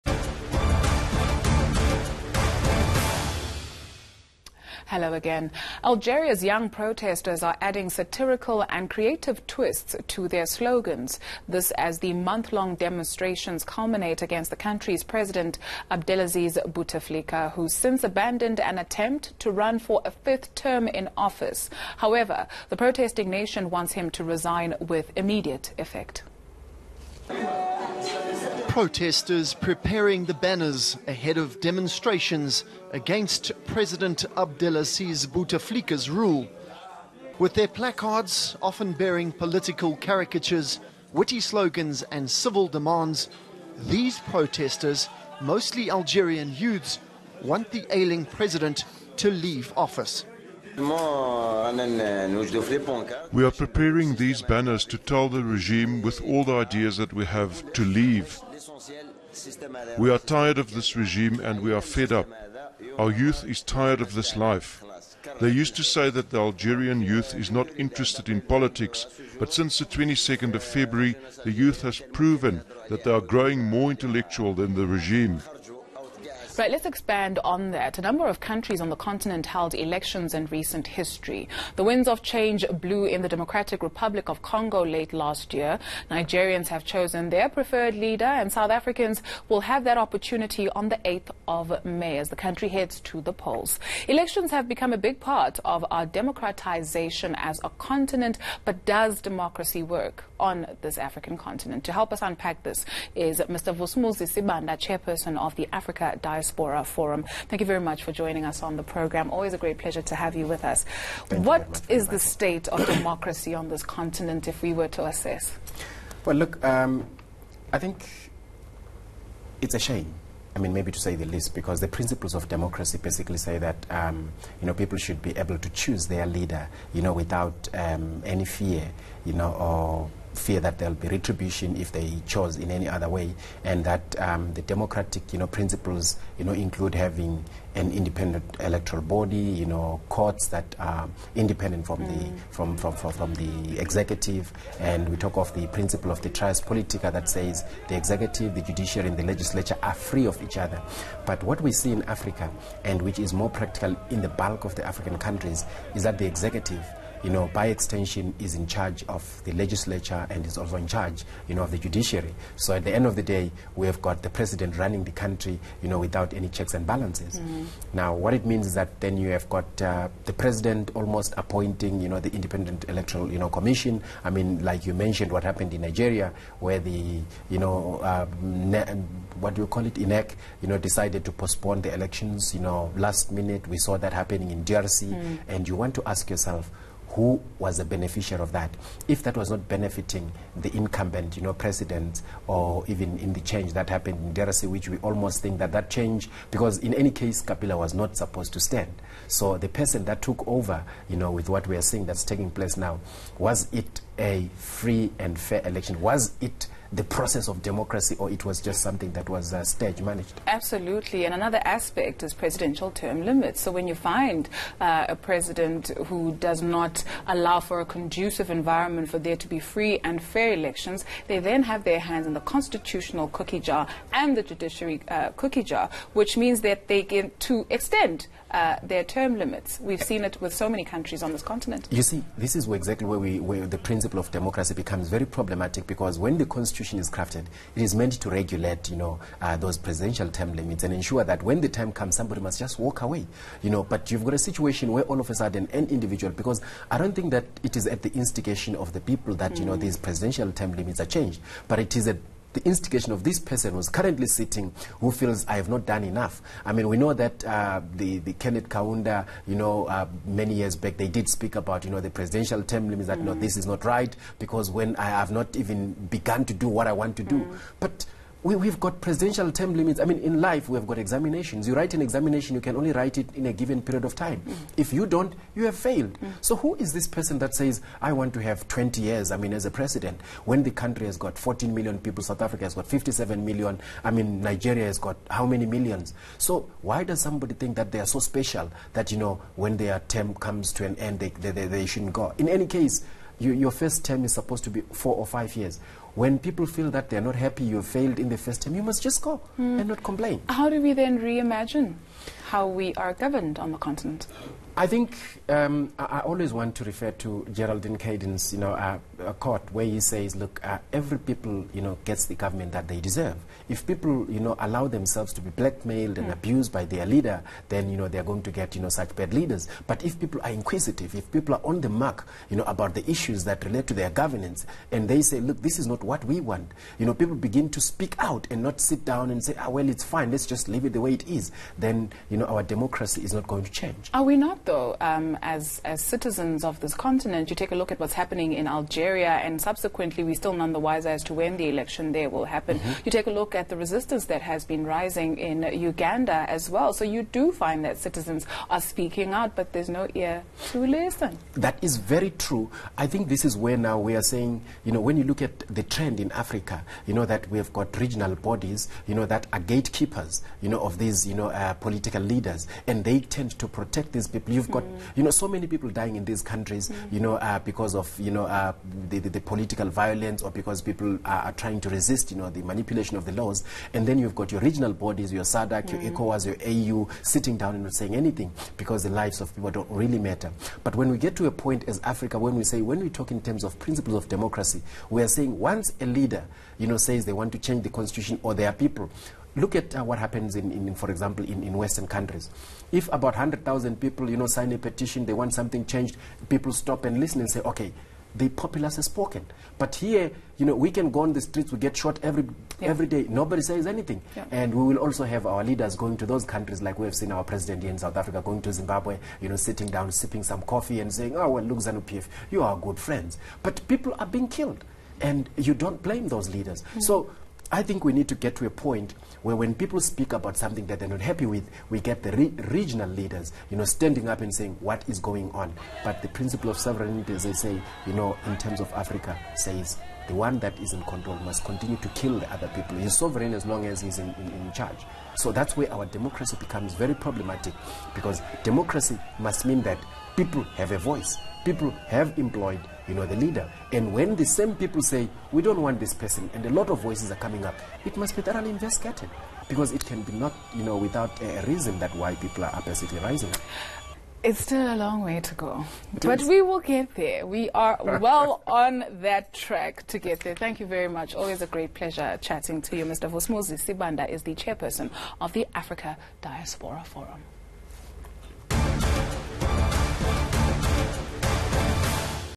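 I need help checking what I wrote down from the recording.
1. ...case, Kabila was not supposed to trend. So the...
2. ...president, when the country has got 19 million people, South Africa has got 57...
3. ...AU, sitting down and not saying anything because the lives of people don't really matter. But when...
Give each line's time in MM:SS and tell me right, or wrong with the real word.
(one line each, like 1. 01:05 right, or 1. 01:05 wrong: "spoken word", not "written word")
1. 03:17 wrong: "stand", not "trend"
2. 04:39 wrong: "14", not "19"
3. 06:17 right.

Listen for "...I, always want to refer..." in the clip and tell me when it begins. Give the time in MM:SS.
05:05.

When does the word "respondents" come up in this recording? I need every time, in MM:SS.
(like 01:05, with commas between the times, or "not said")
not said.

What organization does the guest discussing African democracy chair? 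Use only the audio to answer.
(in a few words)
Africa Diaspora Forum.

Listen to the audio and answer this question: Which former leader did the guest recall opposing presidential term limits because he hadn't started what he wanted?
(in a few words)
Kenneth Kaunda.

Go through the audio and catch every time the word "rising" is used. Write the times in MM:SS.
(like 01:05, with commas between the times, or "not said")
05:44, 07:33.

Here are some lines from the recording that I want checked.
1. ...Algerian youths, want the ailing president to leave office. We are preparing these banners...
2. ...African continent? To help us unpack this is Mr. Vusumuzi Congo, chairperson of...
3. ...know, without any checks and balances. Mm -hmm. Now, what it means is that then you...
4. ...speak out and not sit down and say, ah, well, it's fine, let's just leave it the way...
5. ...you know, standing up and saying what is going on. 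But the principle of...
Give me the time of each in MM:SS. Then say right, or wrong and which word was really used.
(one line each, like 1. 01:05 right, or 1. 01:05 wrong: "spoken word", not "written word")
1. 00:45 right
2. 01:40 wrong: "Sibanda", not "Congo"
3. 02:45 right
4. 05:27 right
5. 07:03 right.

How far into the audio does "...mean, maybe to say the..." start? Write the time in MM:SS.
02:00.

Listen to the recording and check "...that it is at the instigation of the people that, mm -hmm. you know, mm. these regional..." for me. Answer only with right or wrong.
wrong.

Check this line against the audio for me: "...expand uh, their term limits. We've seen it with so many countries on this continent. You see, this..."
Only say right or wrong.
wrong.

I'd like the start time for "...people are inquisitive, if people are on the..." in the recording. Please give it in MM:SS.
05:20.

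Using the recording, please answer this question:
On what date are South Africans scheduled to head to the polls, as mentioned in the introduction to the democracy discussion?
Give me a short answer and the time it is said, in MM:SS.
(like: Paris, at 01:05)
8th of May, at 01:31.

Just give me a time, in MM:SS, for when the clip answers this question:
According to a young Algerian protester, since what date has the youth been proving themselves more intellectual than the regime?
01:09.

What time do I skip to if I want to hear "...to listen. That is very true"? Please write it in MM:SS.
05:50.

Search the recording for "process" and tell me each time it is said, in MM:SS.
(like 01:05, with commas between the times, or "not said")
03:27.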